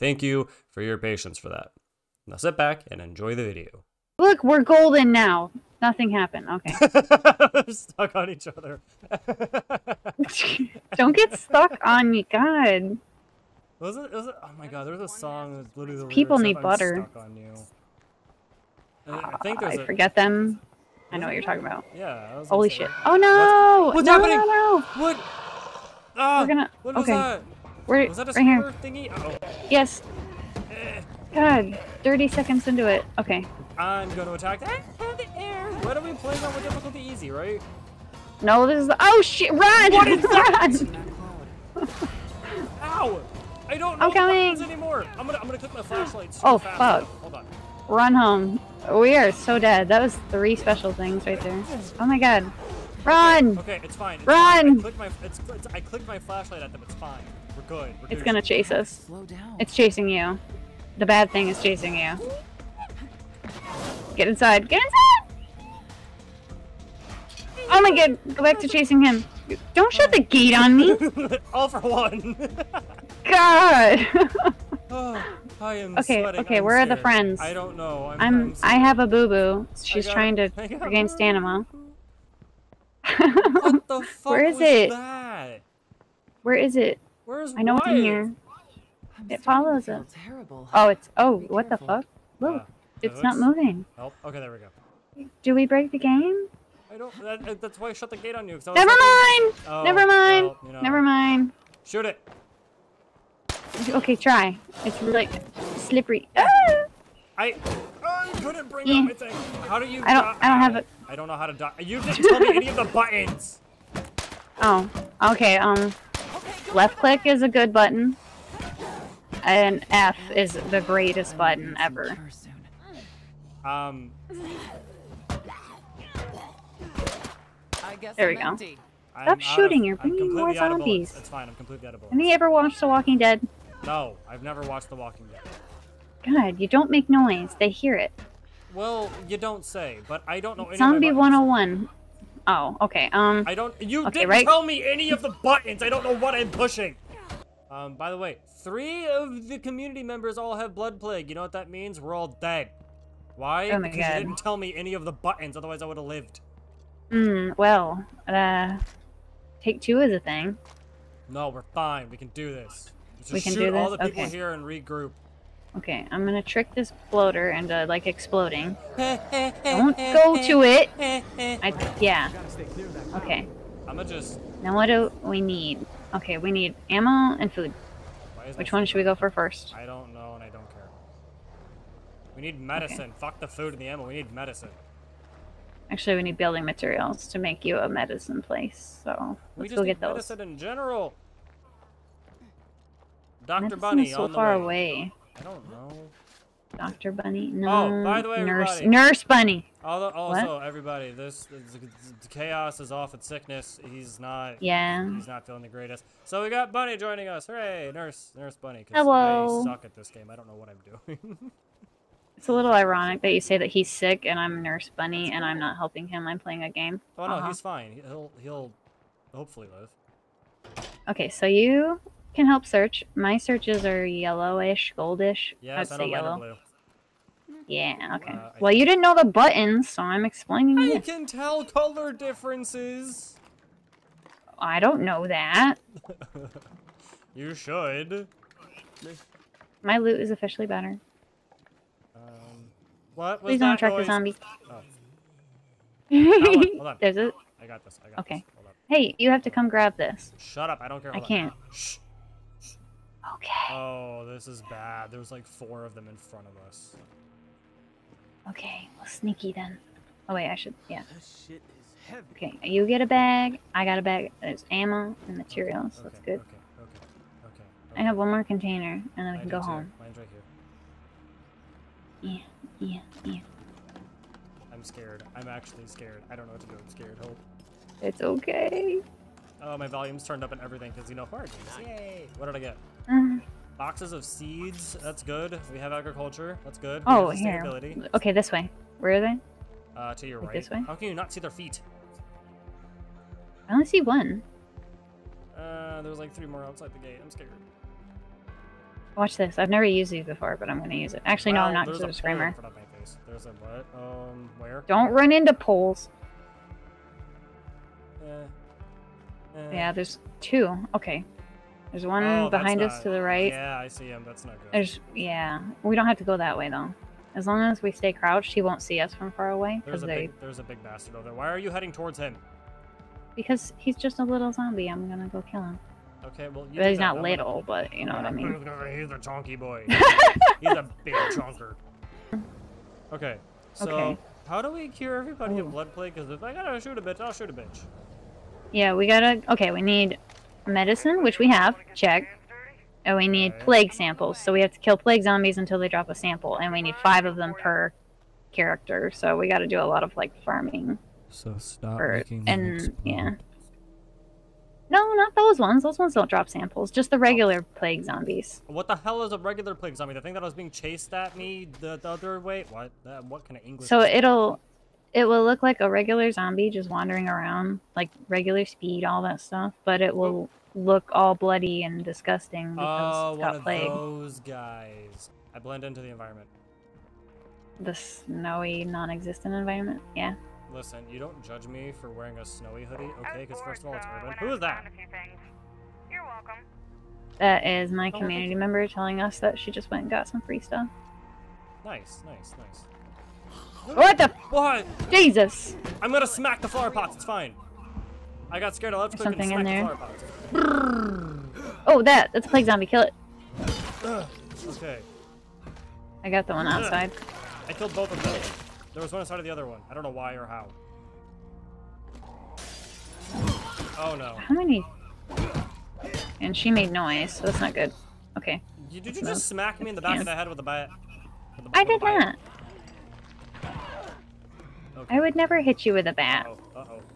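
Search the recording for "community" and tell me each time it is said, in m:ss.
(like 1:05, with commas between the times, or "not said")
2:29, 6:28.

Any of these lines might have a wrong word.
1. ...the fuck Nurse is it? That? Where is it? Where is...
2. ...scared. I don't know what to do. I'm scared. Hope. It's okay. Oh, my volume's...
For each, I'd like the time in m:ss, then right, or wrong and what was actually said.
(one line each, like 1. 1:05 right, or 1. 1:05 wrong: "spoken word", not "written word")
1. 1:23 wrong: "Where", not "Nurse"
2. 4:35 right.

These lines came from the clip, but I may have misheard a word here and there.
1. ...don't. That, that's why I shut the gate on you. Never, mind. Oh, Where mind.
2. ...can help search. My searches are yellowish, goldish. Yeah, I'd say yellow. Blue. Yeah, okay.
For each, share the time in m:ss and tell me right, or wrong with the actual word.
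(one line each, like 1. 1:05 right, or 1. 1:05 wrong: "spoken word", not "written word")
1. 1:36 wrong: "Never", not "Where"
2. 3:42 right.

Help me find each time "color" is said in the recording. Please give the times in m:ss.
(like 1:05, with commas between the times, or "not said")
3:51.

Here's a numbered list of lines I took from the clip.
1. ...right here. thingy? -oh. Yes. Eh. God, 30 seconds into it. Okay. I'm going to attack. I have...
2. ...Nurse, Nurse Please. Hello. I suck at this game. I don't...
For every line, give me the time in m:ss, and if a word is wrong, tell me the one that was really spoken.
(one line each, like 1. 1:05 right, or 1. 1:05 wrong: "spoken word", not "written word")
1. 0:28 right
2. 3:27 wrong: "Bunny", not "Please".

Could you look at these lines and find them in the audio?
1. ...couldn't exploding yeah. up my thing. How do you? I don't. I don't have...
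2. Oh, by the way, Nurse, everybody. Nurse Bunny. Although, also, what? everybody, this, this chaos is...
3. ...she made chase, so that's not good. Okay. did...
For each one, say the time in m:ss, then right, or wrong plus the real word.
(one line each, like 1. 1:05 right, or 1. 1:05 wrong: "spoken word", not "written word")
1. 1:48 wrong: "bring", not "exploding"
2. 3:18 right
3. 6:56 wrong: "noise", not "chase".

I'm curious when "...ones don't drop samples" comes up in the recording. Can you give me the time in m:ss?
5:55.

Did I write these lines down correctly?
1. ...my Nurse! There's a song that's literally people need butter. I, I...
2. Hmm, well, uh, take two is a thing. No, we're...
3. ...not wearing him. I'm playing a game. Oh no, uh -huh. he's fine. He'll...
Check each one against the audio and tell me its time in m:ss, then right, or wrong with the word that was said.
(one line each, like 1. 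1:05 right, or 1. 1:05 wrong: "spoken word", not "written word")
1. 0:14 wrong: "God", not "Nurse"
2. 2:37 right
3. 3:35 wrong: "helping", not "wearing".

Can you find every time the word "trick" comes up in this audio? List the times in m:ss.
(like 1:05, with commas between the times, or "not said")
2:46.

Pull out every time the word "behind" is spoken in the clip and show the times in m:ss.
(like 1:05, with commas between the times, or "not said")
5:12.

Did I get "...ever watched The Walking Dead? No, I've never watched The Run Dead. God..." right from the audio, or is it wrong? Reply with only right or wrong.
wrong.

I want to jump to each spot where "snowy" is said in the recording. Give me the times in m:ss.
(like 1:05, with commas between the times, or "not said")
6:17, 6:22.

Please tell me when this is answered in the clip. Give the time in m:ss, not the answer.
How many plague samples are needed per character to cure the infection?
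5:46.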